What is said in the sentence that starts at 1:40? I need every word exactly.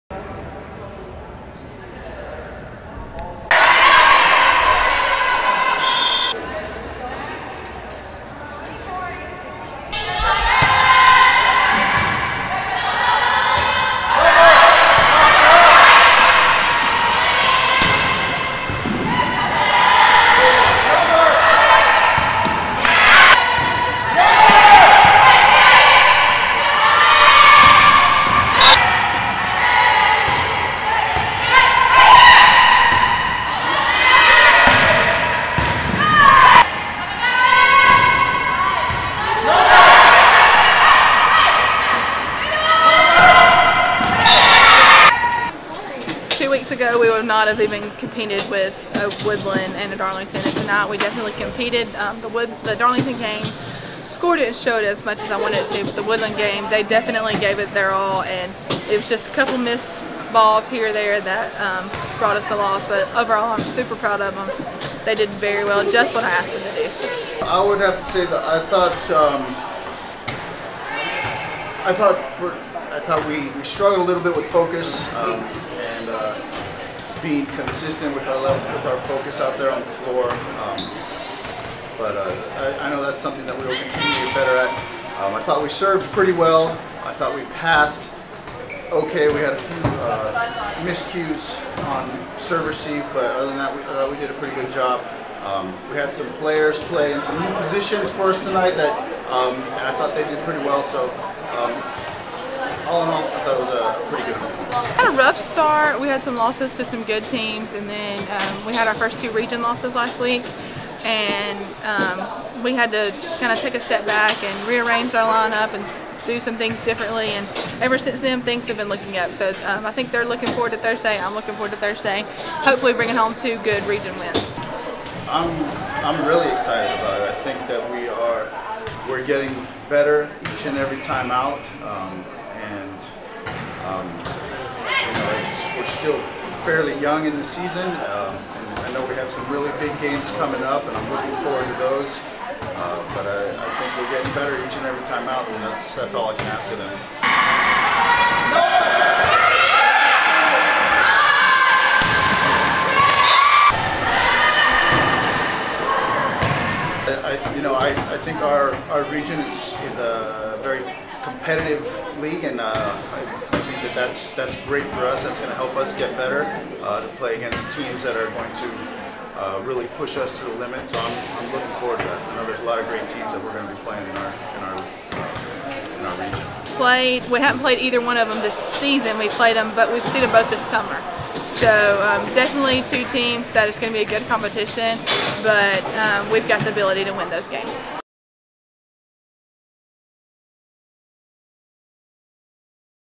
So um, had a rough start.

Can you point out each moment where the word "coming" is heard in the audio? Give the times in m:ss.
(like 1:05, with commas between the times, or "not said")
2:20.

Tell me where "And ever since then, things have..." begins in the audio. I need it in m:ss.
1:57.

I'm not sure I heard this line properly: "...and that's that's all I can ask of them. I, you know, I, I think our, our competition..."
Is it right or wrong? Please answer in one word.
wrong.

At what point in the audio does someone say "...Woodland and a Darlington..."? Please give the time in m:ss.
0:49.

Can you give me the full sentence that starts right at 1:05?
They did very well, just what I asked them to do.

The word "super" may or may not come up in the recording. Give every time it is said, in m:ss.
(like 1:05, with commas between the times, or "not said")
1:03.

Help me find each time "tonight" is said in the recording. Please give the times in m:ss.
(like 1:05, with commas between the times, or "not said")
0:50, 1:38.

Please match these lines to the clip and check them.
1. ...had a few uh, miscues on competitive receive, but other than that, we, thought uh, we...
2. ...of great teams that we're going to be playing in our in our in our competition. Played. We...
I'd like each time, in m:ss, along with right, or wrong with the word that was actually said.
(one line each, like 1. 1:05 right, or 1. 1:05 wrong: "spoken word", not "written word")
1. 1:29 wrong: "serve", not "competitive"
2. 2:52 wrong: "region", not "competition".